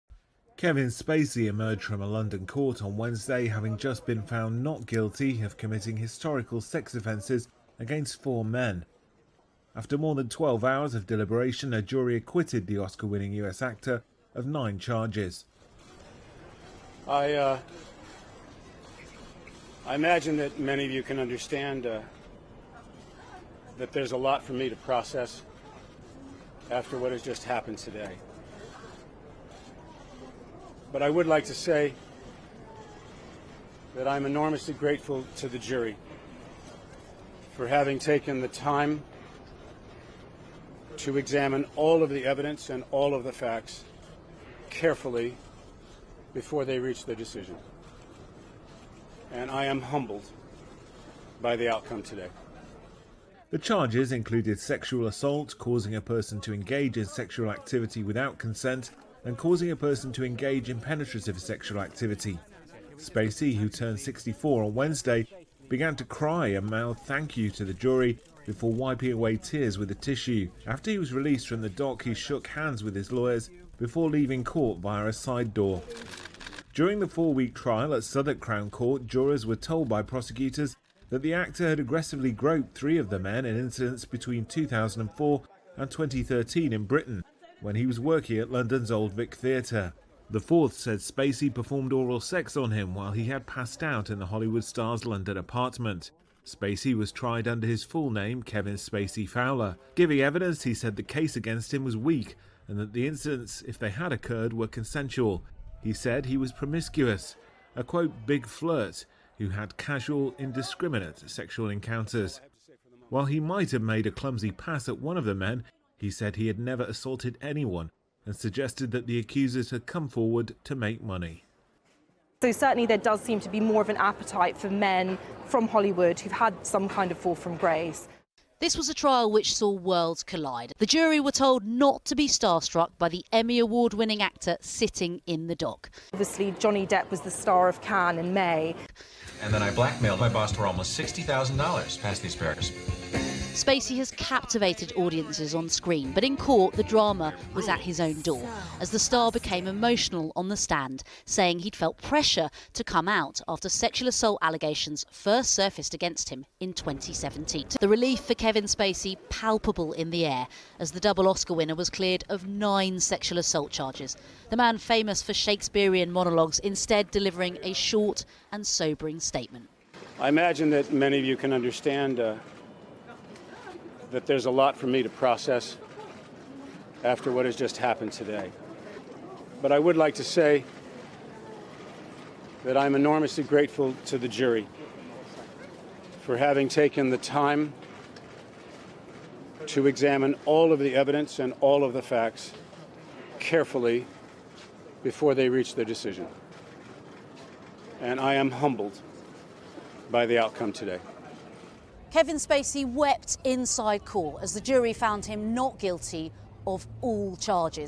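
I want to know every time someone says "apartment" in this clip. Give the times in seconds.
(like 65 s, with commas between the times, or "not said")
95 s.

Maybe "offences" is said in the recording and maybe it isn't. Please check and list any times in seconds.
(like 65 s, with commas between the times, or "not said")
6 s.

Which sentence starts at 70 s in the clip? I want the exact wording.
After he was released from the dock, he shook hands with his lawyers before leaving court via a side door.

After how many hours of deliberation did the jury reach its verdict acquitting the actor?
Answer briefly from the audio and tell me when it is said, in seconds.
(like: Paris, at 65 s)
more than 12, at 9 s.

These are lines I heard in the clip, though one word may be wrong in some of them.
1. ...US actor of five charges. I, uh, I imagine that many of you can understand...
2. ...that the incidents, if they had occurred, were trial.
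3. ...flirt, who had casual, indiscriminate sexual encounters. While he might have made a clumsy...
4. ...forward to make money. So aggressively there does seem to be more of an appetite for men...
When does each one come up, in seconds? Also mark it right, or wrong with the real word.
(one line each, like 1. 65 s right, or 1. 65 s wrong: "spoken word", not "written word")
1. 13 s wrong: "nine", not "five"
2. 102 s wrong: "consensual", not "trial"
3. 108 s right
4. 120 s wrong: "certainly", not "aggressively".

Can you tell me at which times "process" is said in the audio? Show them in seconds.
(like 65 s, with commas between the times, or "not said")
24 s, 175 s.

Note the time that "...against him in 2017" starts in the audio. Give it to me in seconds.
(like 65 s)
155 s.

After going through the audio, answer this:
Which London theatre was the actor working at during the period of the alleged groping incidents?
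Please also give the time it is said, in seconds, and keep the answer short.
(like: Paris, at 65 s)
Old Vic Theatre, at 88 s.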